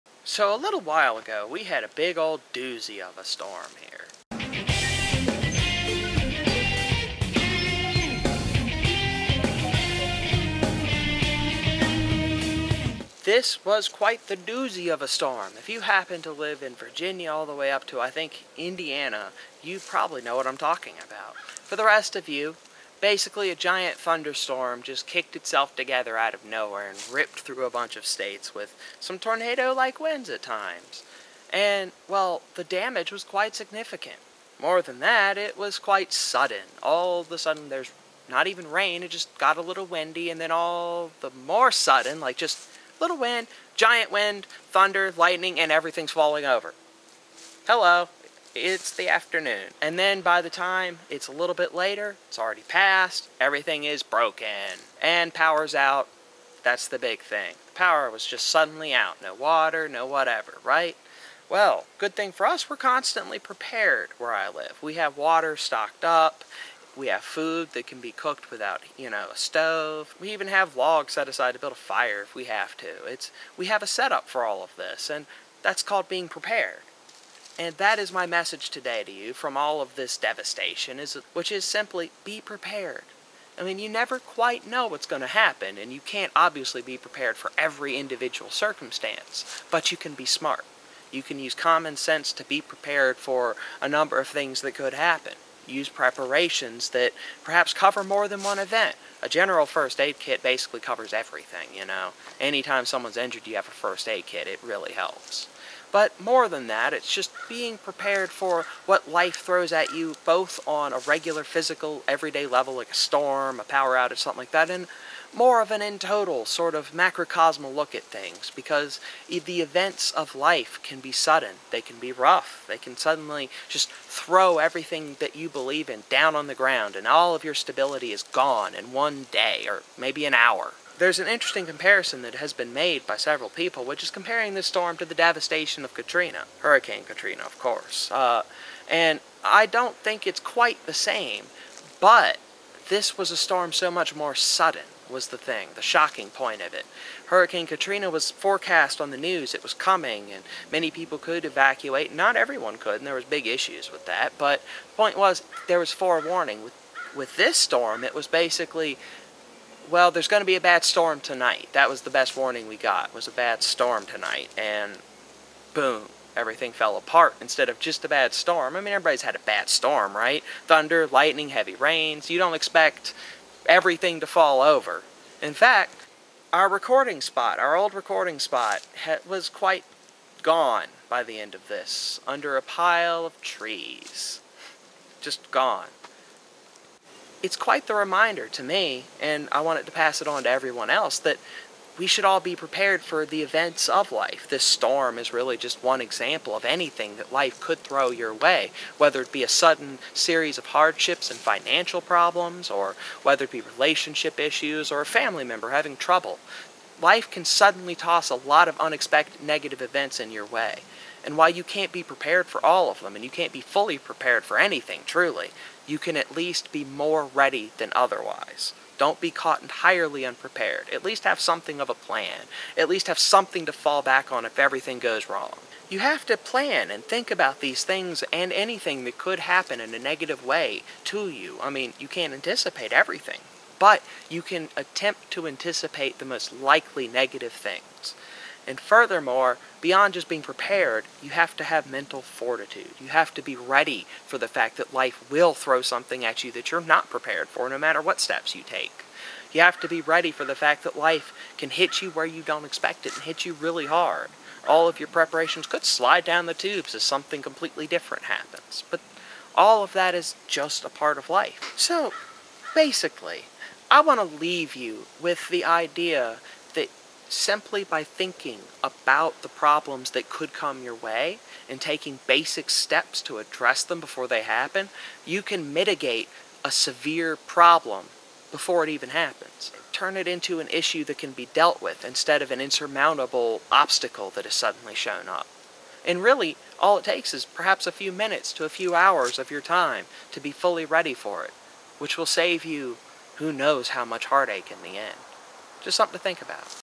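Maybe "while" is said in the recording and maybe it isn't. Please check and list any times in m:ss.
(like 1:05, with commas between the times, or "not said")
0:00, 3:31.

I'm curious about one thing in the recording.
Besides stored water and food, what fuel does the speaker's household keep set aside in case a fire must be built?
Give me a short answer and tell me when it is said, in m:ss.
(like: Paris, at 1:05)
logs, at 1:10.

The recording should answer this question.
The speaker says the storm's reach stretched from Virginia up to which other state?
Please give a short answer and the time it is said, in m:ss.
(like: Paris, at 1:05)
Indiana, at 0:18.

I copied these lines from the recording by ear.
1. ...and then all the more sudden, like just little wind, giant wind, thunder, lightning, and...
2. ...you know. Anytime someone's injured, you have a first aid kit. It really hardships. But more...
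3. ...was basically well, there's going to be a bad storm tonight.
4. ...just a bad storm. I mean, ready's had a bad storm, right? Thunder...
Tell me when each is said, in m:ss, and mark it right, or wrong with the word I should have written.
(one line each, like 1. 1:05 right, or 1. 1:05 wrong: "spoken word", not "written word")
1. 0:40 right
2. 1:41 wrong: "helps", not "hardships"
3. 2:38 right
4. 2:47 wrong: "everybody", not "ready".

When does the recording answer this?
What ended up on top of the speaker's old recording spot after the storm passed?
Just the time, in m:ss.
3:02.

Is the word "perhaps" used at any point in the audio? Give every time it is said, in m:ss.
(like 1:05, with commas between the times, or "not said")
1:37, 4:47.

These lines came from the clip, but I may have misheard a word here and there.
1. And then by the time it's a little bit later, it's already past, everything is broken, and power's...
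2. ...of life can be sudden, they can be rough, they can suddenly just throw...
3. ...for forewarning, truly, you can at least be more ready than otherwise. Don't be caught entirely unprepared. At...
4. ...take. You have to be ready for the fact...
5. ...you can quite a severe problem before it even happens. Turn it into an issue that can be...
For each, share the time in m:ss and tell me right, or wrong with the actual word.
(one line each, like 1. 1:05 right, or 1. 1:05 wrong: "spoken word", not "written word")
1. 0:49 right
2. 2:00 right
3. 3:34 wrong: "anything", not "forewarning"
4. 4:08 right
5. 4:35 wrong: "mitigate", not "quite".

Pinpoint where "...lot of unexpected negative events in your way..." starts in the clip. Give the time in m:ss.
3:28.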